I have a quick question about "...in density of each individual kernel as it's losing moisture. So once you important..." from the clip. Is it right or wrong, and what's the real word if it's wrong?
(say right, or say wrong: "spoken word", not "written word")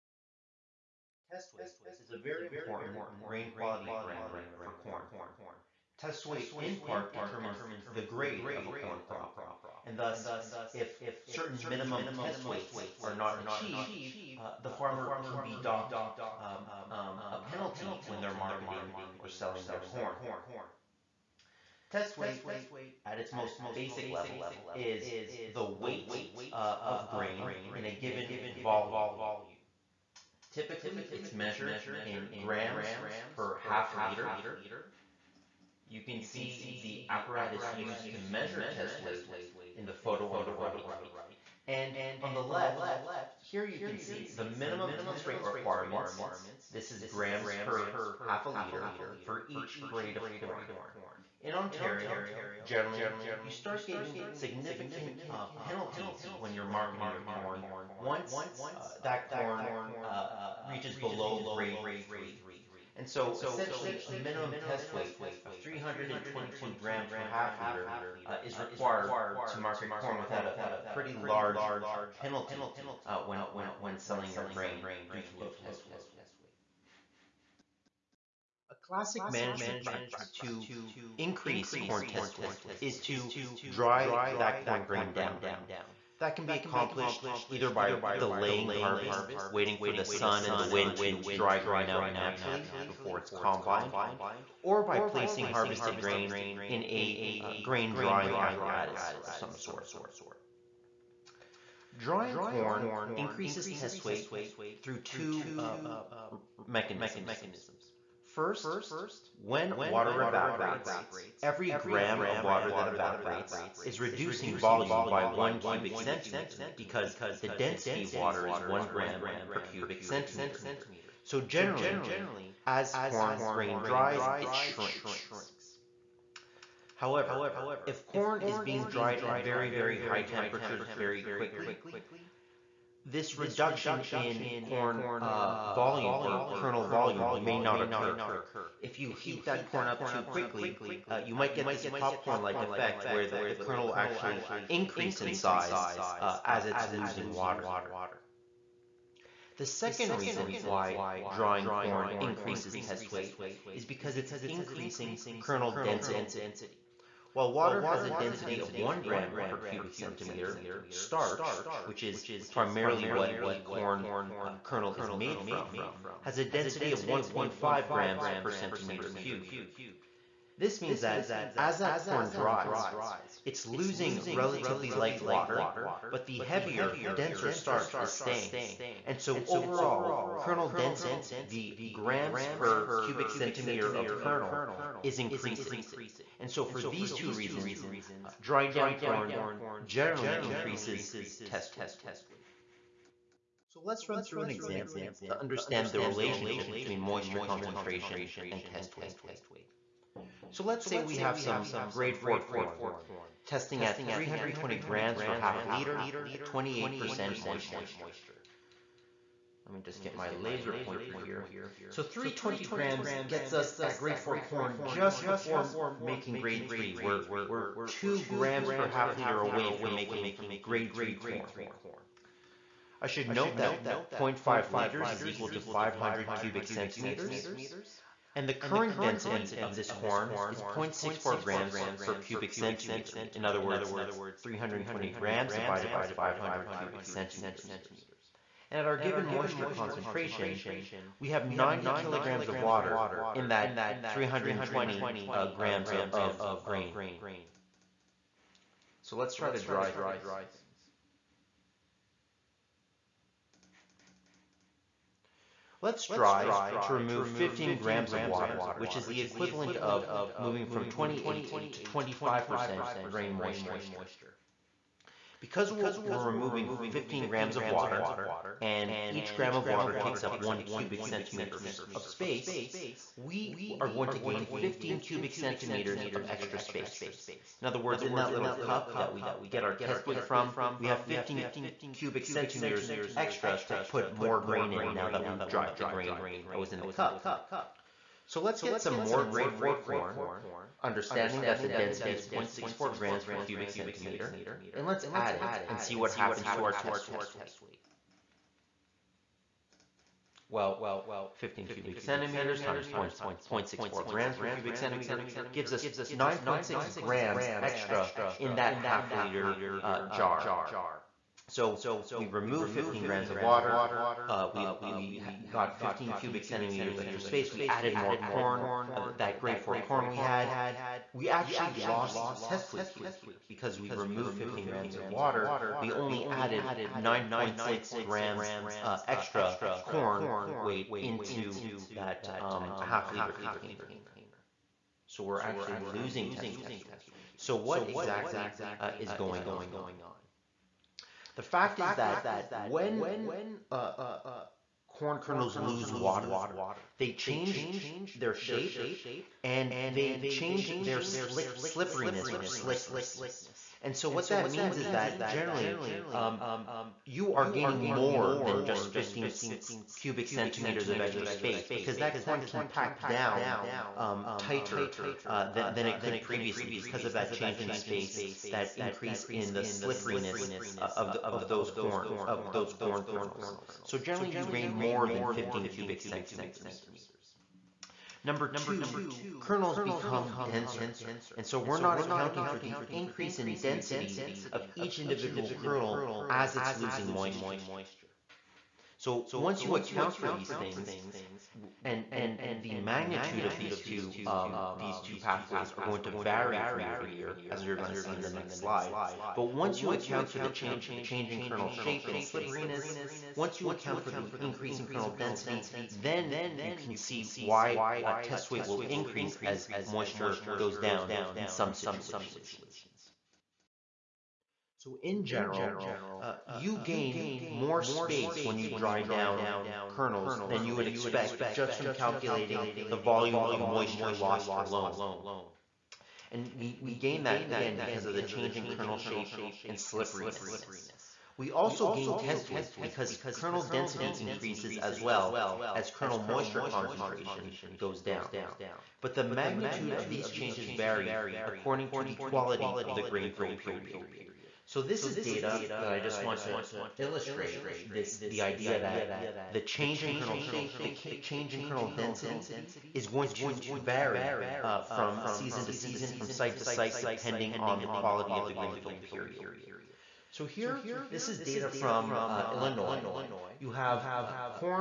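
wrong: "account", not "important".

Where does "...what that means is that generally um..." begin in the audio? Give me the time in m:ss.
5:54.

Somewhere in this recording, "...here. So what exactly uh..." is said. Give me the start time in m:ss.
5:36.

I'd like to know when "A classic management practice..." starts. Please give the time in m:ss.
1:18.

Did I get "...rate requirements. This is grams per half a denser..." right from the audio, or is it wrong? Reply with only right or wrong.
wrong.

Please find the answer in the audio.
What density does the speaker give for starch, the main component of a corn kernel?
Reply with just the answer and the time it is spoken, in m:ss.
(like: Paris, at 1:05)
1.5 grams per cubic centimeter, at 2:47.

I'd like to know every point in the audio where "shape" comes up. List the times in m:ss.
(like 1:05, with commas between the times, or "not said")
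5:48, 6:41, 7:08, 7:30.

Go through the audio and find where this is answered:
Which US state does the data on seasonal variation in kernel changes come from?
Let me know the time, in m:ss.
7:42.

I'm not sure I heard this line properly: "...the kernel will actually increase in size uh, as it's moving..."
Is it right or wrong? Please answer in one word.
wrong.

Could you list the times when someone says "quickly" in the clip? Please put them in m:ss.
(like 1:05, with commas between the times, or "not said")
2:11, 2:20.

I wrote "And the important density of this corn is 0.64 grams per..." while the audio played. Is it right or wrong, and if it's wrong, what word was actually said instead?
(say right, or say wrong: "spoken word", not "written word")
wrong: "current", not "important".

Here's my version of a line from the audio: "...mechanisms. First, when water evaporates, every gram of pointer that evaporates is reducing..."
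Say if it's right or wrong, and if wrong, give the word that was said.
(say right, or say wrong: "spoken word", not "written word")
wrong: "water", not "pointer".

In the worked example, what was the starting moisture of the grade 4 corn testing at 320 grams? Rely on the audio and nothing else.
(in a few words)
28%.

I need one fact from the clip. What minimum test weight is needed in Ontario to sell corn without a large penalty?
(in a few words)
322 grams per half liter.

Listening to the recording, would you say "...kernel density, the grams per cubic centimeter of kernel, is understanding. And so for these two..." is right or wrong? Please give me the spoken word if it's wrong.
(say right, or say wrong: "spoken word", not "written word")
wrong: "increasing", not "understanding".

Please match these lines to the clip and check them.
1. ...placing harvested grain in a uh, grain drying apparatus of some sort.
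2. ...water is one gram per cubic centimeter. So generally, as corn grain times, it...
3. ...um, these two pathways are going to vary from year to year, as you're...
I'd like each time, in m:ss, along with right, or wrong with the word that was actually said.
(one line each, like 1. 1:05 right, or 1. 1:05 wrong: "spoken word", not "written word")
1. 1:34 right
2. 1:58 wrong: "dries", not "times"
3. 6:34 right.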